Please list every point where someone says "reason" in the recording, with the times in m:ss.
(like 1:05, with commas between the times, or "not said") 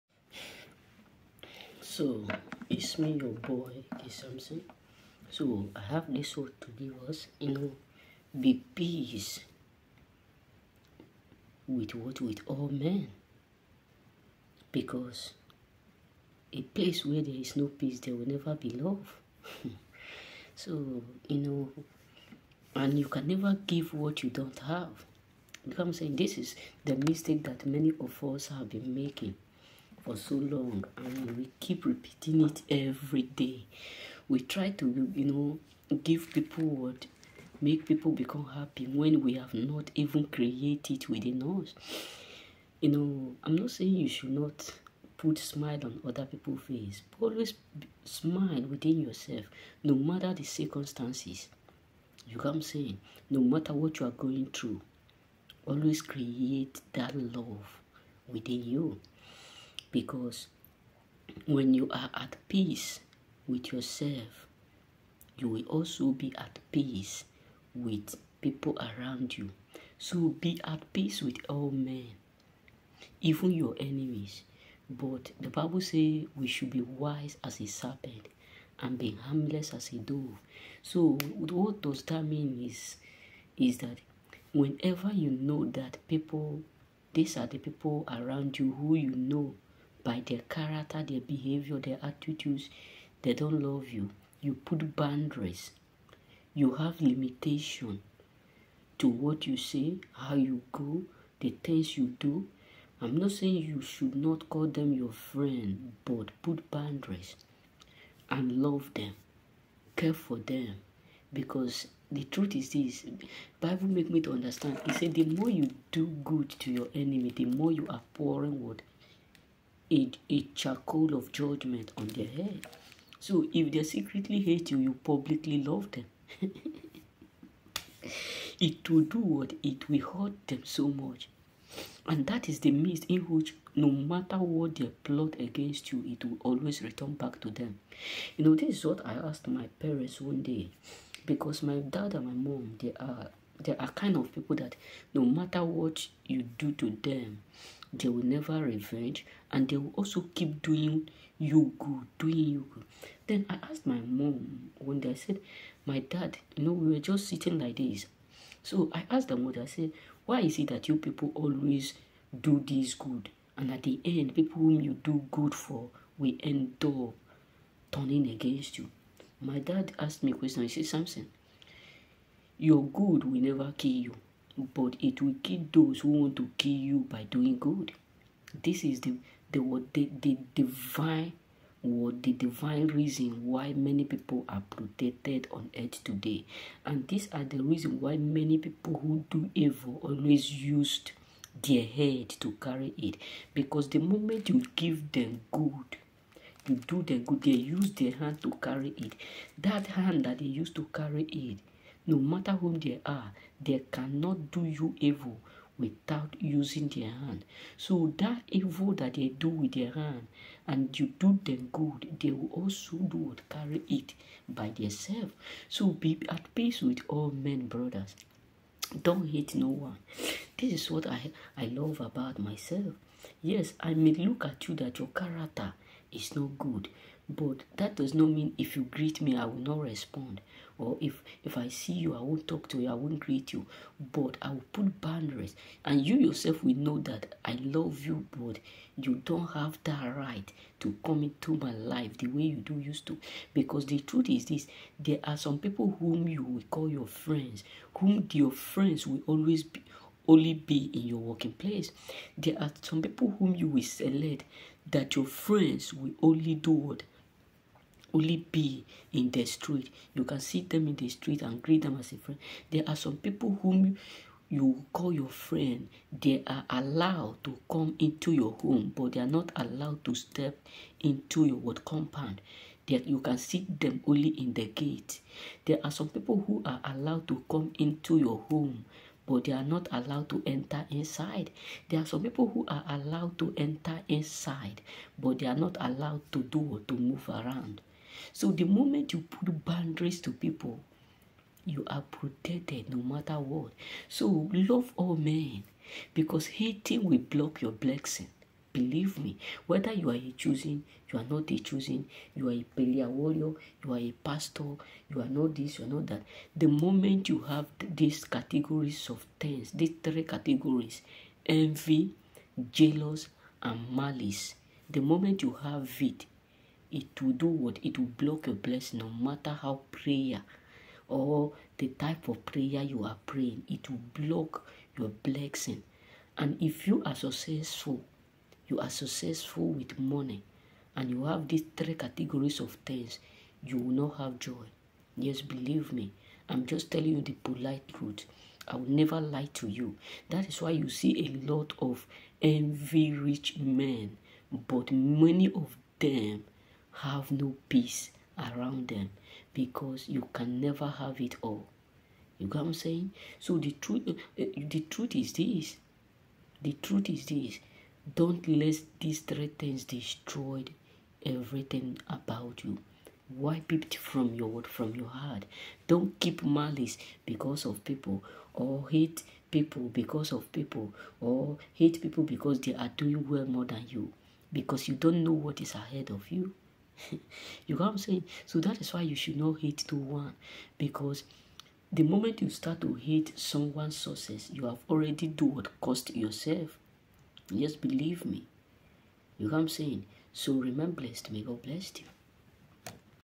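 3:02, 3:07.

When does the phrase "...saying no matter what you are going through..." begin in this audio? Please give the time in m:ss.
0:52.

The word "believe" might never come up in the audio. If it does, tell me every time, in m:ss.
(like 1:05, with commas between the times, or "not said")
4:58, 5:35, 6:27.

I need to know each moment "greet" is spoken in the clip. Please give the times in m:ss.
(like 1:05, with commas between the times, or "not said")
3:48, 3:53, 4:21.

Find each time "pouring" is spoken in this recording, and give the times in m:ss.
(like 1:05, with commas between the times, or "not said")
1:58.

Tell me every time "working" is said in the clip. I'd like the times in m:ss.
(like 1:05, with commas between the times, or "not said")
4:11.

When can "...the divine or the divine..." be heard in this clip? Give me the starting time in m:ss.
3:00.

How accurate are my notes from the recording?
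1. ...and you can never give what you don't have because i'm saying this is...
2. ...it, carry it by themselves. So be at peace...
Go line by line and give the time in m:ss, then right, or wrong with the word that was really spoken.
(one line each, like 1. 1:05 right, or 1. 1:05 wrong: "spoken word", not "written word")
1. 0:22 right
2. 3:33 right.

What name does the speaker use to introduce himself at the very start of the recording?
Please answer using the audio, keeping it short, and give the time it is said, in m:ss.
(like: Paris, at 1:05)
K Samson, at 0:03.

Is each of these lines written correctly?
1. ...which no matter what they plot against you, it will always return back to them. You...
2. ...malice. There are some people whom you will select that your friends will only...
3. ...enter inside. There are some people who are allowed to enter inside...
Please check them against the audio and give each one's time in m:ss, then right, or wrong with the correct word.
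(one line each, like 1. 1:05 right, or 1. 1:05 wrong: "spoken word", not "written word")
1. 2:13 right
2. 4:11 wrong: "place", not "malice"
3. 4:40 right.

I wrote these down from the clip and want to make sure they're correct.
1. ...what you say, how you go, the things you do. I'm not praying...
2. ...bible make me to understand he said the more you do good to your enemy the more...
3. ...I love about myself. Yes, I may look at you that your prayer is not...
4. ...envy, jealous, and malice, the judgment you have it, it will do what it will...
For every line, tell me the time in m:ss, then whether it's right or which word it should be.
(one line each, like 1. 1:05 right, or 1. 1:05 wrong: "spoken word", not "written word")
1. 1:39 wrong: "saying", not "praying"
2. 1:53 right
3. 3:41 wrong: "character", not "prayer"
4. 5:11 wrong: "moment", not "judgment".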